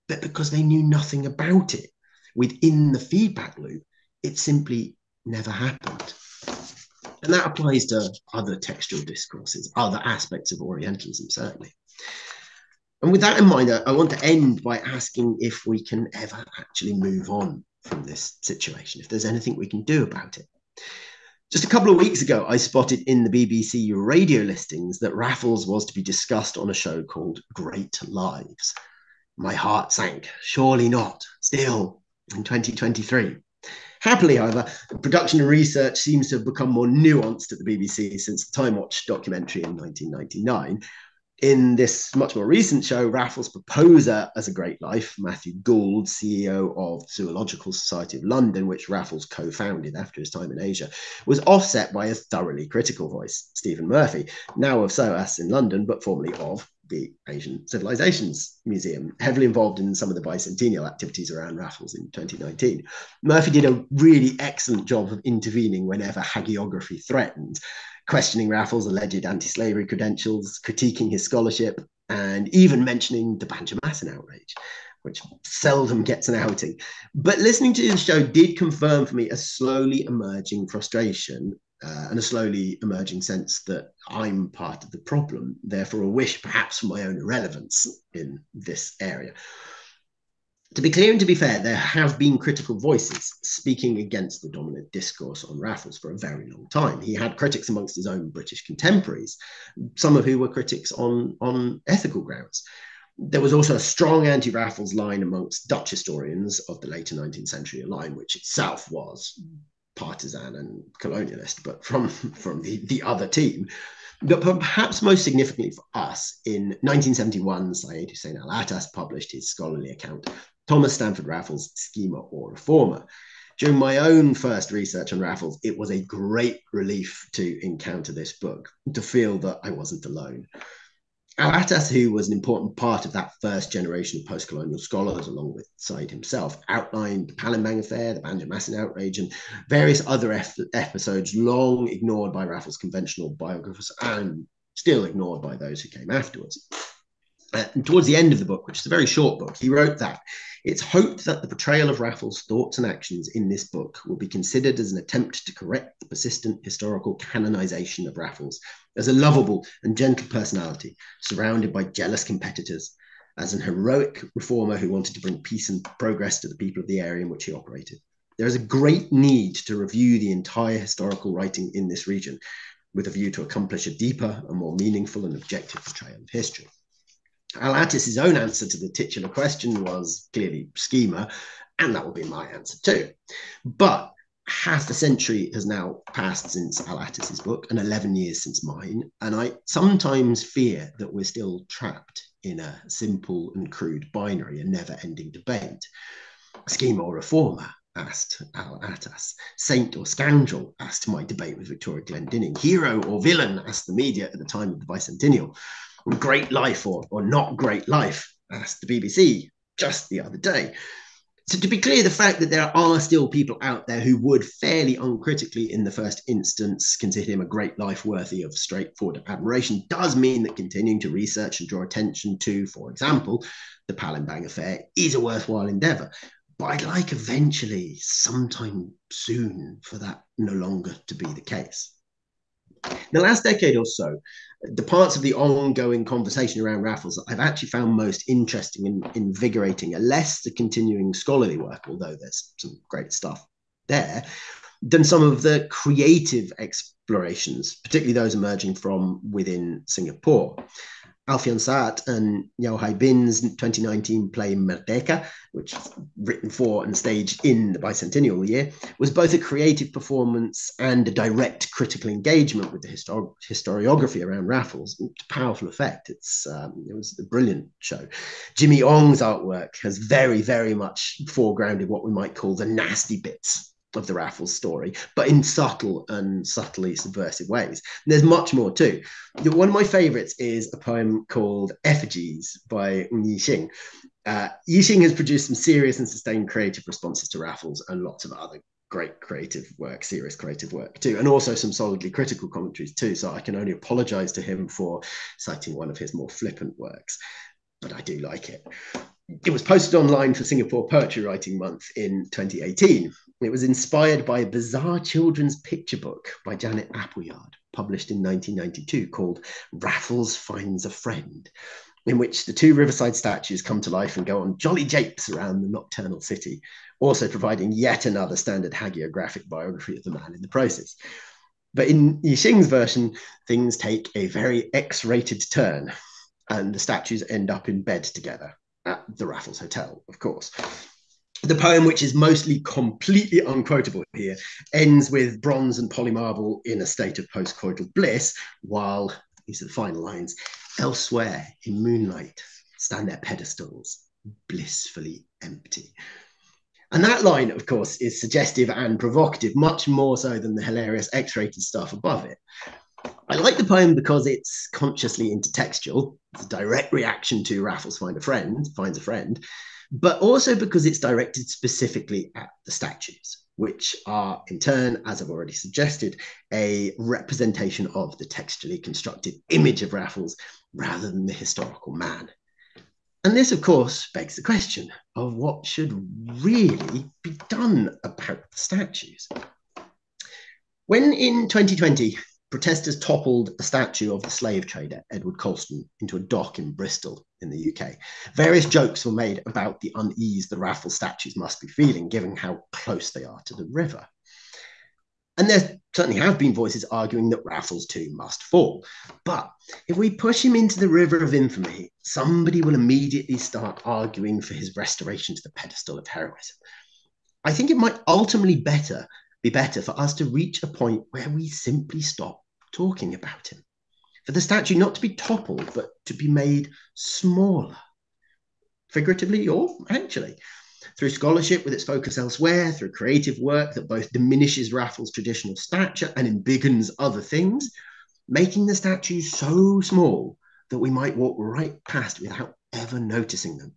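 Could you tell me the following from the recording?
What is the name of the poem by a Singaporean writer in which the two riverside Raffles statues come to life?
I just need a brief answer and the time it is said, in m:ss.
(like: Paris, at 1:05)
Effigies, at 4:41.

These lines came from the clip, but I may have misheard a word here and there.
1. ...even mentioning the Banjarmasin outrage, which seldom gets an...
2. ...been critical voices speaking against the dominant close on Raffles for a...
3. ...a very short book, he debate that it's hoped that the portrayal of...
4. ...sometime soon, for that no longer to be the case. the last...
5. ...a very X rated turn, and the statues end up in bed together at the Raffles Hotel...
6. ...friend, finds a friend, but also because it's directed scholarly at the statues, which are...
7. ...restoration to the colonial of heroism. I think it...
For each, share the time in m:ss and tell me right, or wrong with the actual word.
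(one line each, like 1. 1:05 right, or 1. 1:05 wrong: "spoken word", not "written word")
1. 1:12 right
2. 1:32 wrong: "discourse", not "close"
3. 2:28 wrong: "wrote", not "debate"
4. 3:47 right
5. 5:24 right
6. 5:58 wrong: "specifically", not "scholarly"
7. 6:44 wrong: "pedestal", not "colonial".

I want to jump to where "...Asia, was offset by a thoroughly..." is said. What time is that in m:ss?
0:50.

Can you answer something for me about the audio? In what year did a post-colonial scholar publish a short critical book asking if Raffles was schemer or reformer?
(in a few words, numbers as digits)
1971.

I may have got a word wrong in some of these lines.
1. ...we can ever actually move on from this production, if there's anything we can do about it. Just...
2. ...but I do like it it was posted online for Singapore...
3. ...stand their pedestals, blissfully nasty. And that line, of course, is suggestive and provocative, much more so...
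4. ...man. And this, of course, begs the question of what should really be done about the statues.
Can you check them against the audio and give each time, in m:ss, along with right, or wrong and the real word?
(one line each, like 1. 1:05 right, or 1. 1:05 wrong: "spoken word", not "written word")
1. 0:15 wrong: "situation", not "production"
2. 4:57 right
3. 5:42 wrong: "empty", not "nasty"
4. 6:11 right.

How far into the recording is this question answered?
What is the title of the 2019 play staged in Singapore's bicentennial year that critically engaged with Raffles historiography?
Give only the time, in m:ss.
4:14.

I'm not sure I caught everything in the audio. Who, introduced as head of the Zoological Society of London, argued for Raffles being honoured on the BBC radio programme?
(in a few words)
Matthew Gould.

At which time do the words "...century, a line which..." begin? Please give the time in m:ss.
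1:47.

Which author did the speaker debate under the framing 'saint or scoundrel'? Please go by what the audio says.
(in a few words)
Victoria Glendinning.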